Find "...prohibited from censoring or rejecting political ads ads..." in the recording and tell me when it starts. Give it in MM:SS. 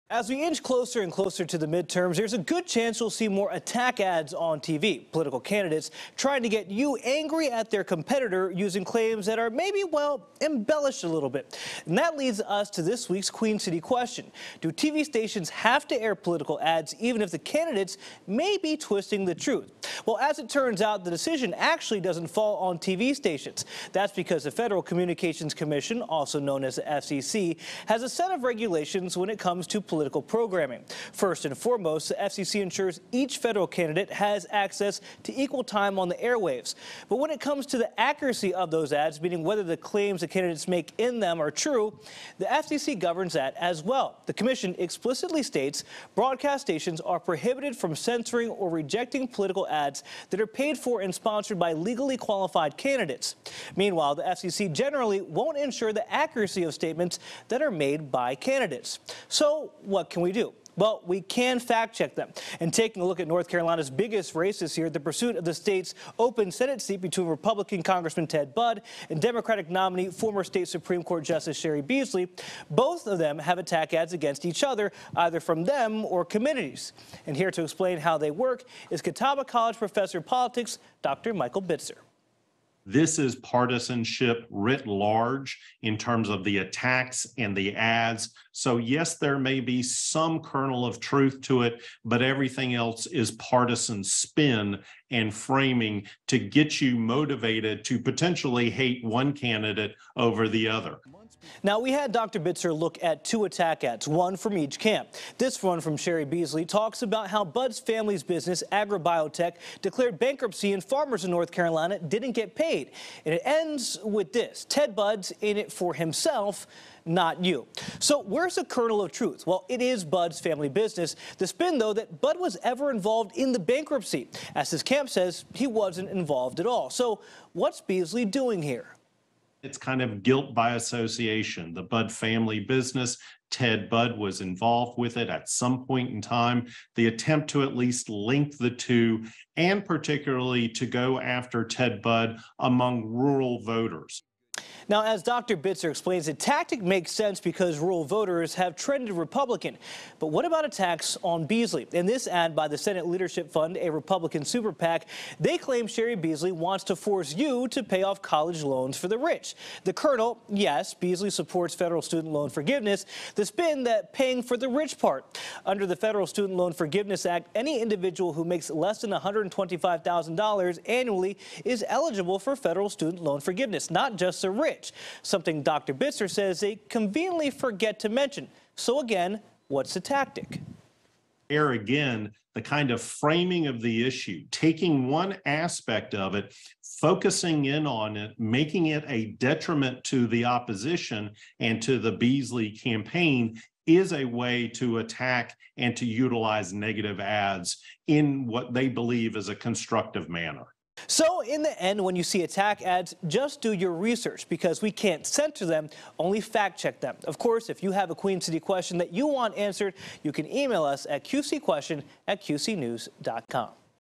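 00:47.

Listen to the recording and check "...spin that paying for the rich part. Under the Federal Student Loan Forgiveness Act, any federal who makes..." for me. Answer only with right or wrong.
wrong.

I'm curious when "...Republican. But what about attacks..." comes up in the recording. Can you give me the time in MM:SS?
02:29.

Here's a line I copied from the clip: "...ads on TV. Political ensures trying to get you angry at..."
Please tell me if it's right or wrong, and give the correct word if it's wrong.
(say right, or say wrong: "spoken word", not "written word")
wrong: "candidates", not "ensures".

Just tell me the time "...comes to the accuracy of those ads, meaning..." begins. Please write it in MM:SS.
00:37.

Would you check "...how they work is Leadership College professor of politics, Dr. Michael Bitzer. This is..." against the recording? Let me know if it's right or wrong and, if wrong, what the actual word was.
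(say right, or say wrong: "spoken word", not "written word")
wrong: "Catawba", not "Leadership".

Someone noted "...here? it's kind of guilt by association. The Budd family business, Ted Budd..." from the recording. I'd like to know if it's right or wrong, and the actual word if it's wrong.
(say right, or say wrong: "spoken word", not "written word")
right.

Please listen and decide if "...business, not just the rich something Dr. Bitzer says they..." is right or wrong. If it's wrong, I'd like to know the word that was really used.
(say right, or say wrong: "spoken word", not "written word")
wrong: "forgiveness", not "business".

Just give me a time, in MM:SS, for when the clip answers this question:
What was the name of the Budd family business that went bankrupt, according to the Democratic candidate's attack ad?
01:48.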